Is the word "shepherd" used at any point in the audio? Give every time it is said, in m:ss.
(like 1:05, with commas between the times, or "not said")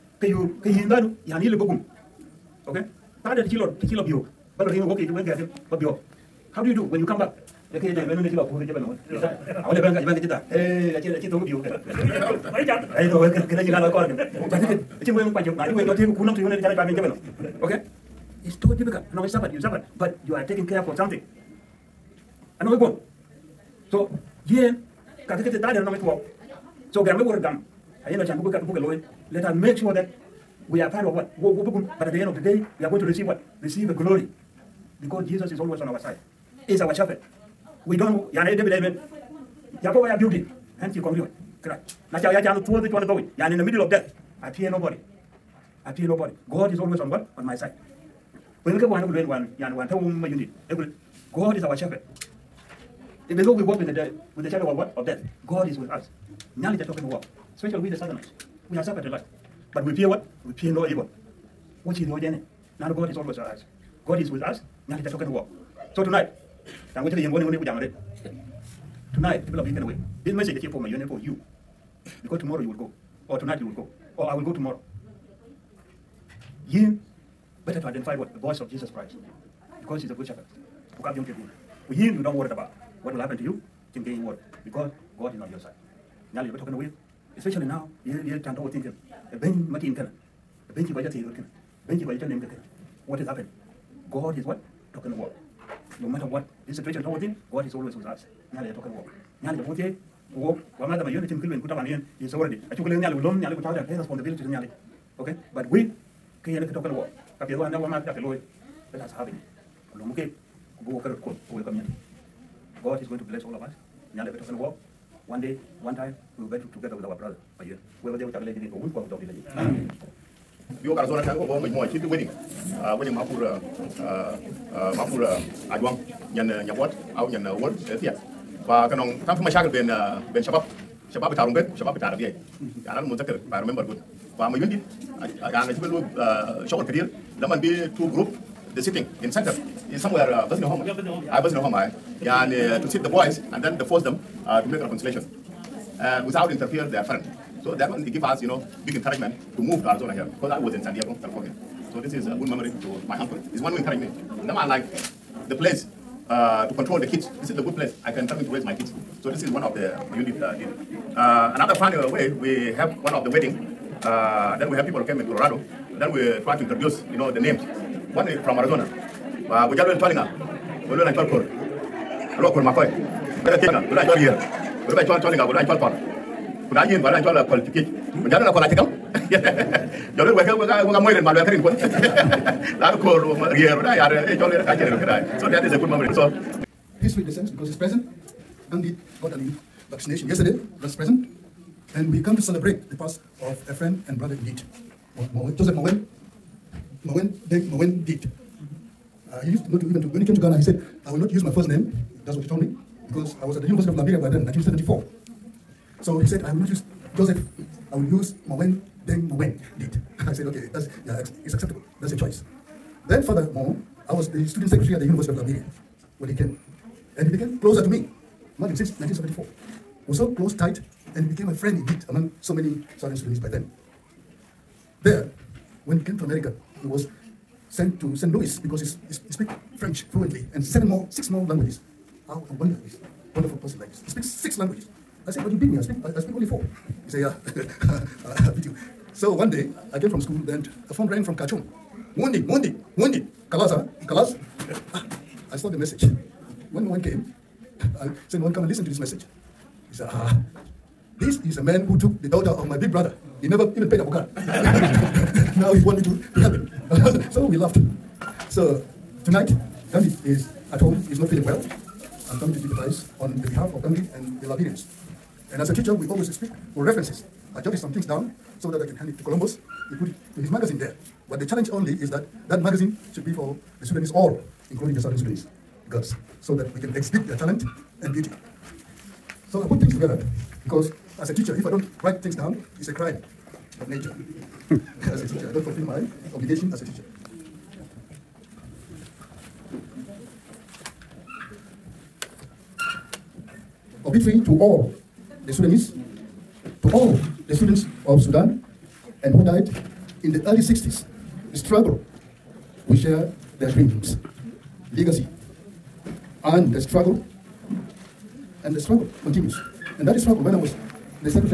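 0:36, 0:51, 1:20.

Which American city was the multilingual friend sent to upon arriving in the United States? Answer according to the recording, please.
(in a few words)
St. Louis.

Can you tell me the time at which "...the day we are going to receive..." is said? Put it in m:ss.
0:32.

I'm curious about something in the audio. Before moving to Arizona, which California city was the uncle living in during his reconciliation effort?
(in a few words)
San Diego.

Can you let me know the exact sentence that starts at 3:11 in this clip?
And we come to celebrate the past of a friend and brother Indeed, Joseph Mawien, Mawien Deng Mawien did.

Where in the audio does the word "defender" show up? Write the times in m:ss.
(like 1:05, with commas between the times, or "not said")
not said.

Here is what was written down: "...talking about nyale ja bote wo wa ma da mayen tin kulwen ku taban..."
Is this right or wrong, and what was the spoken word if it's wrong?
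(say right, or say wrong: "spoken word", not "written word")
right.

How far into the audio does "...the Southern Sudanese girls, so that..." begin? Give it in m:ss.
4:34.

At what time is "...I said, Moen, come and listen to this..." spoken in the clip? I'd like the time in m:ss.
4:08.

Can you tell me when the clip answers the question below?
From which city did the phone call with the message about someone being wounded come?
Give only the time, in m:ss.
4:01.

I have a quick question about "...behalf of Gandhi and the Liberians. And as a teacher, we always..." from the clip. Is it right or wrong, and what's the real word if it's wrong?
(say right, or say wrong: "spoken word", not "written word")
right.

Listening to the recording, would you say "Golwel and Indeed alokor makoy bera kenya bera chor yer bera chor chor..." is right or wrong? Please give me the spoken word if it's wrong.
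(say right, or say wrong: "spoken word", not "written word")
wrong: "Twalkor", not "Indeed".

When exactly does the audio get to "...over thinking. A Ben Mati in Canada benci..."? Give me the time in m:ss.
1:28.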